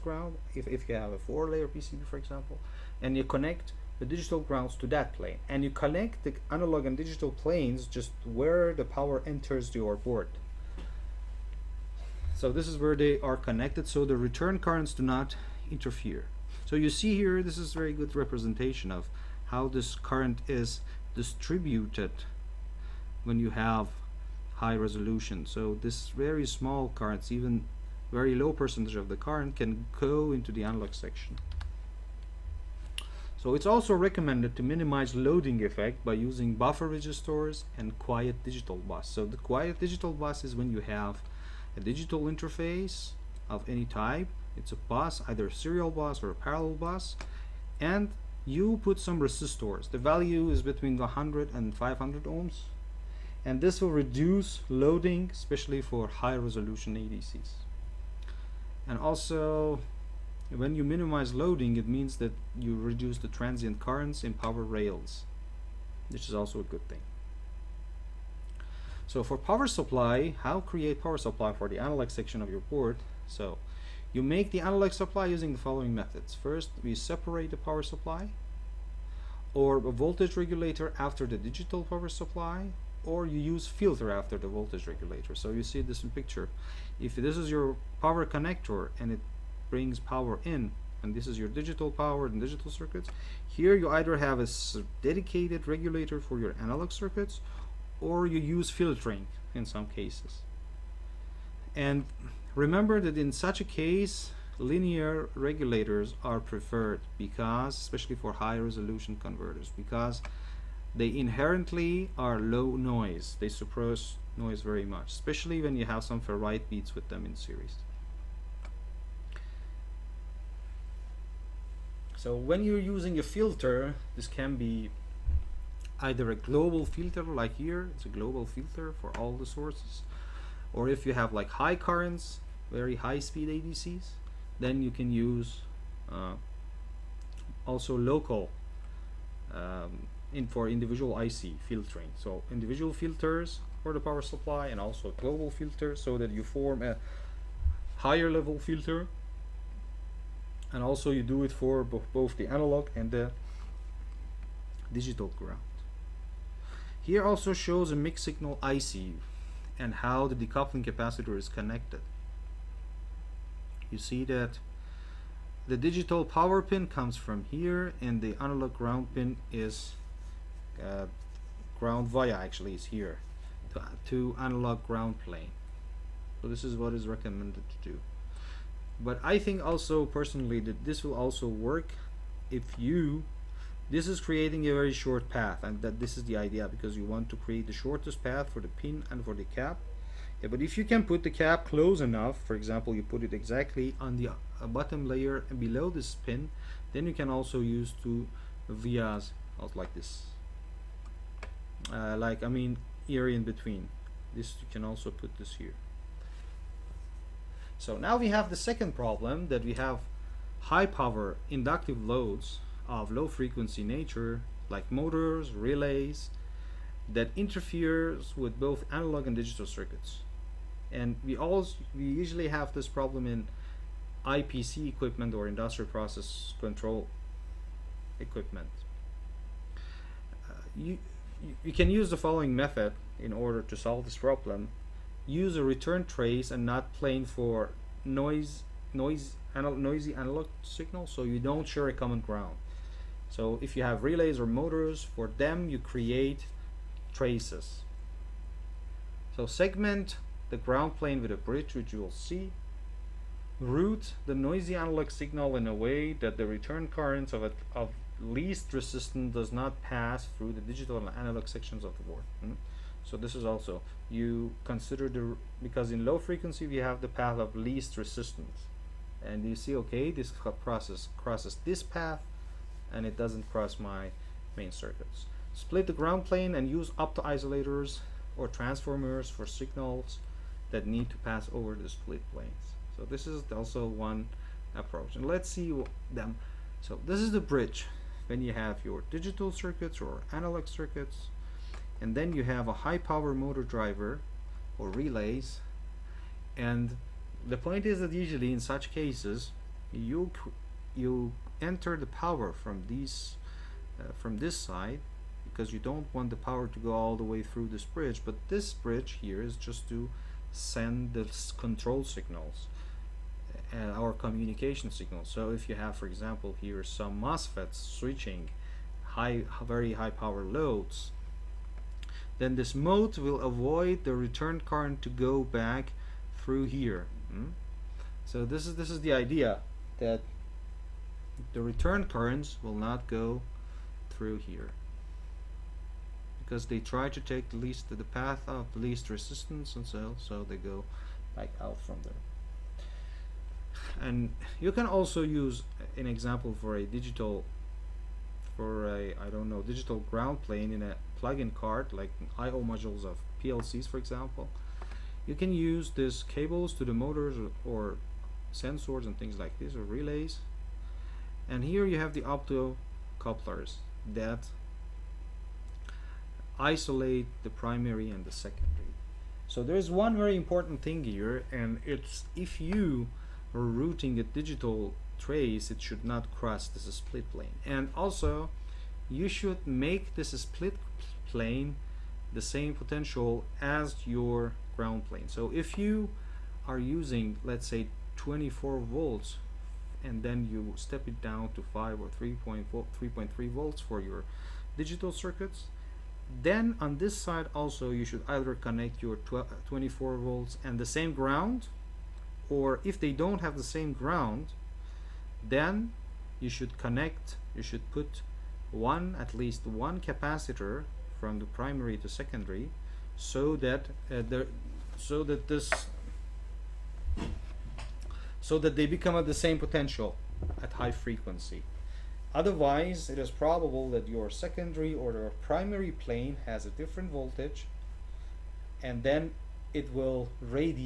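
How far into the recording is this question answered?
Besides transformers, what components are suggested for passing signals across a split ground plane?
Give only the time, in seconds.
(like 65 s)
276 s.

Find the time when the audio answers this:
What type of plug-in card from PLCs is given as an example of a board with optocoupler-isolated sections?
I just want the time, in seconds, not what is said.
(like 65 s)
352 s.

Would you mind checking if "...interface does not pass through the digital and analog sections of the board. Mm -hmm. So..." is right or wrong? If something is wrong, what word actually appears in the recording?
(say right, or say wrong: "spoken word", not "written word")
wrong: "resistance", not "interface".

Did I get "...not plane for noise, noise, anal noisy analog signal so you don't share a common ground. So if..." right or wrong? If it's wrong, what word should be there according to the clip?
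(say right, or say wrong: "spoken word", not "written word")
right.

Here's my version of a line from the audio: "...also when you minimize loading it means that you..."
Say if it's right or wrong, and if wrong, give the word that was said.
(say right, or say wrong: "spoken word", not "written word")
right.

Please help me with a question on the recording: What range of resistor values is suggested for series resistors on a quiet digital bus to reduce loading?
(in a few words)
100 to 500 ohms.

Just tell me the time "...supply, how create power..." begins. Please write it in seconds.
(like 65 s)
69 s.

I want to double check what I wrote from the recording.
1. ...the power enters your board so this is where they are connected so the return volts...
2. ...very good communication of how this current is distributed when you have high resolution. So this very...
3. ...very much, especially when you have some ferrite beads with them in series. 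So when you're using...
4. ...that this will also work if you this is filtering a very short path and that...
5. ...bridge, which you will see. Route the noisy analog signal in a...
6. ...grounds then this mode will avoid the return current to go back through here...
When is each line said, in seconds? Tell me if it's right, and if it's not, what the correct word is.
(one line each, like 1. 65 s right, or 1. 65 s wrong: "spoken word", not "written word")
1. 8 s wrong: "currents", not "volts"
2. 17 s wrong: "representation", not "communication"
3. 114 s right
4. 180 s wrong: "creating", not "filtering"
5. 251 s right
6. 320 s wrong: "loads", not "grounds".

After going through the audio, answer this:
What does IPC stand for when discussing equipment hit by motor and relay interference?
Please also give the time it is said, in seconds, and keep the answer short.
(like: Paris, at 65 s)
Industrial process control, at 225 s.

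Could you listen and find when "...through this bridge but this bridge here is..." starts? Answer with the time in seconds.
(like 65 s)
307 s.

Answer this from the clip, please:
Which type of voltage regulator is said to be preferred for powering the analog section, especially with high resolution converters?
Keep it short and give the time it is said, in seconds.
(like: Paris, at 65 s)
Linear regulators, at 104 s.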